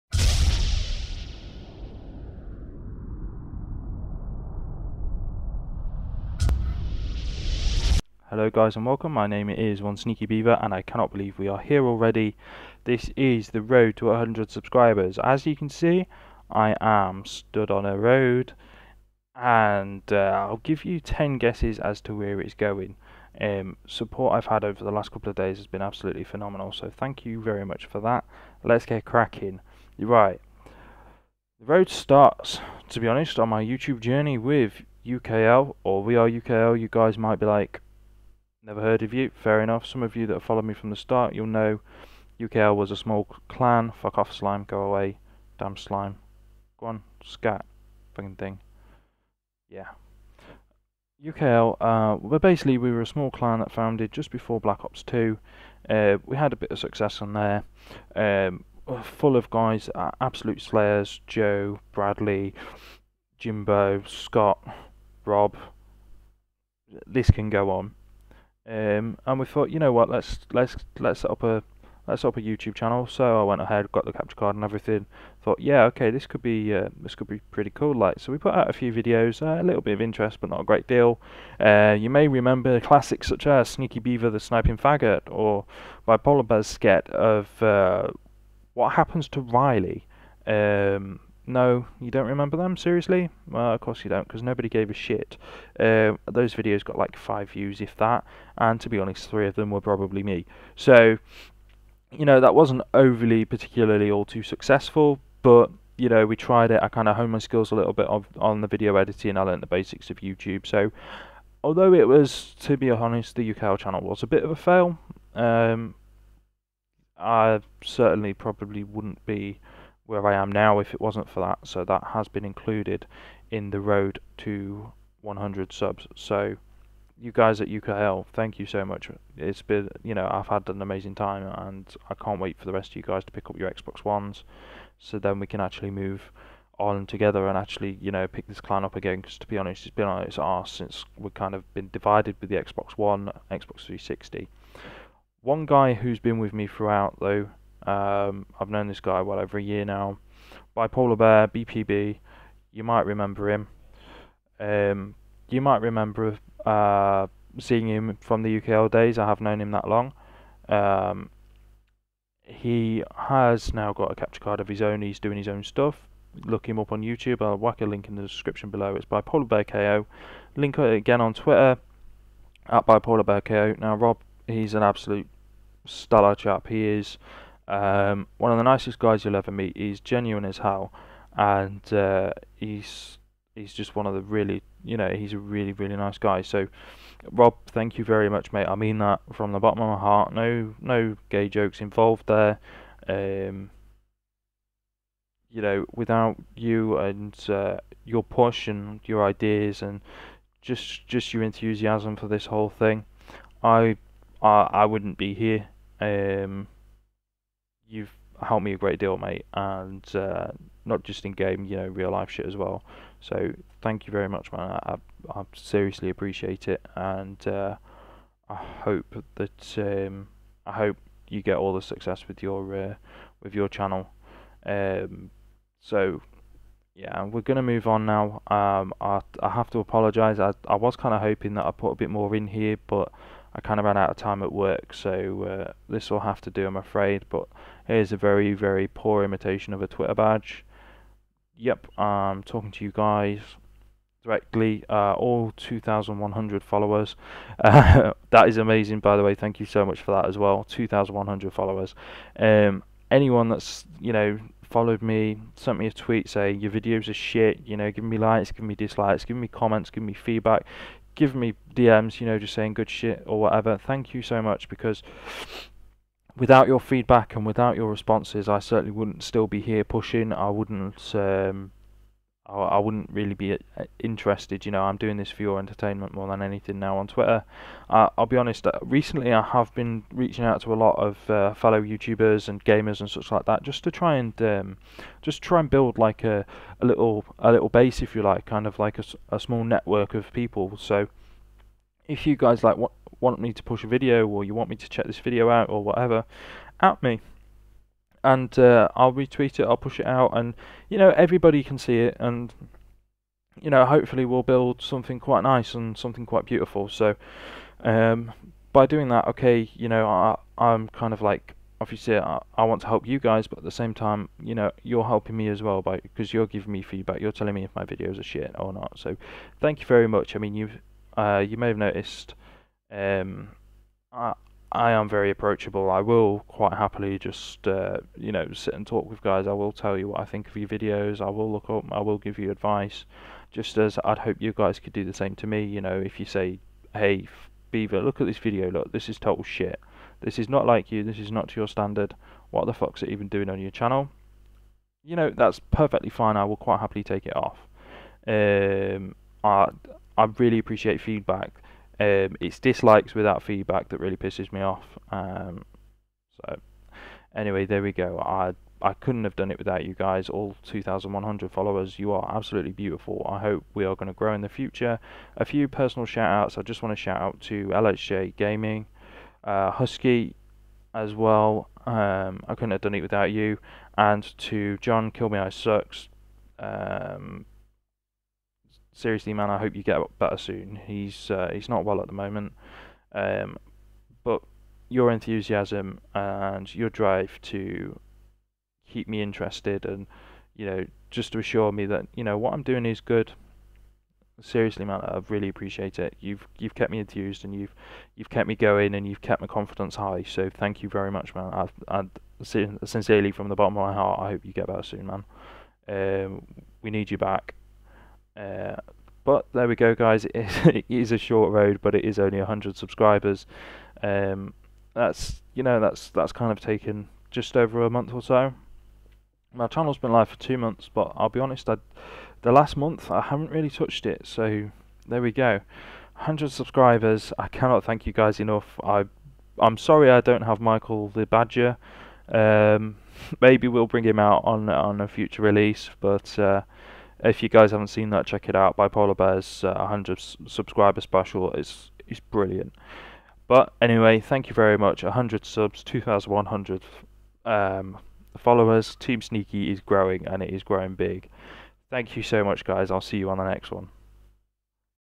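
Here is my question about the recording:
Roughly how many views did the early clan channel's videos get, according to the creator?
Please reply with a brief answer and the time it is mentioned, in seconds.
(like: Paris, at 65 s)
5, at 97 s.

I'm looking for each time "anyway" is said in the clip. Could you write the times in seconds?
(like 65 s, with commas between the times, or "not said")
357 s, 443 s.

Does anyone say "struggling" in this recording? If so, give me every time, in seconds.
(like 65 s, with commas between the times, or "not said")
not said.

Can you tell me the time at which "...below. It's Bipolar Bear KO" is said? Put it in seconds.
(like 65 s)
168 s.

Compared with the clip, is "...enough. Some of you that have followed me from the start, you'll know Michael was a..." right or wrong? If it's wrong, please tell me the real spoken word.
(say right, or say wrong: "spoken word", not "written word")
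wrong: "UKL", not "Michael".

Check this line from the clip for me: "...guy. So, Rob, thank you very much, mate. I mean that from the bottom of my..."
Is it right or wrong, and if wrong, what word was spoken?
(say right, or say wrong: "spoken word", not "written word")
right.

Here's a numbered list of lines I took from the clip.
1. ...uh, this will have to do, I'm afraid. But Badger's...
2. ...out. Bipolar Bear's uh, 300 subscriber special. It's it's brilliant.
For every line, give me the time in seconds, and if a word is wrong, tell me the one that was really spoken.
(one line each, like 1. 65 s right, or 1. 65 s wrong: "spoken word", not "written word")
1. 235 s wrong: "Here", not "Badger"
2. 438 s wrong: "100", not "300".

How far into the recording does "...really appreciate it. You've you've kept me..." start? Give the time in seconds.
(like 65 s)
395 s.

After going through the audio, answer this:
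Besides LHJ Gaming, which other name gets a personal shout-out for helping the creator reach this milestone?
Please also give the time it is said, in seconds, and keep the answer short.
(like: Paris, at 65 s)
Husky, at 369 s.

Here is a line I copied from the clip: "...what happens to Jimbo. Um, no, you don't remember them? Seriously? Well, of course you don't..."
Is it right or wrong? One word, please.
wrong.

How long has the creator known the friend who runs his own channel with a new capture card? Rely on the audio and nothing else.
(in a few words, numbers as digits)
over a year.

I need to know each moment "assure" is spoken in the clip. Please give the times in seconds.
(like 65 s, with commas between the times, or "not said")
391 s.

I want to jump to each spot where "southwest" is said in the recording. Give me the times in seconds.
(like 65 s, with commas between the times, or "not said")
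not said.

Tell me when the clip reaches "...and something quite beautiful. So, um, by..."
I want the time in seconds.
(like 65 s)
305 s.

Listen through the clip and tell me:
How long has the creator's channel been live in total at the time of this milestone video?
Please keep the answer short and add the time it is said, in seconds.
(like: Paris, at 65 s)
2 months, at 420 s.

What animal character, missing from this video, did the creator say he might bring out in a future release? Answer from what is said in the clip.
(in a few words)
Michael the Badger.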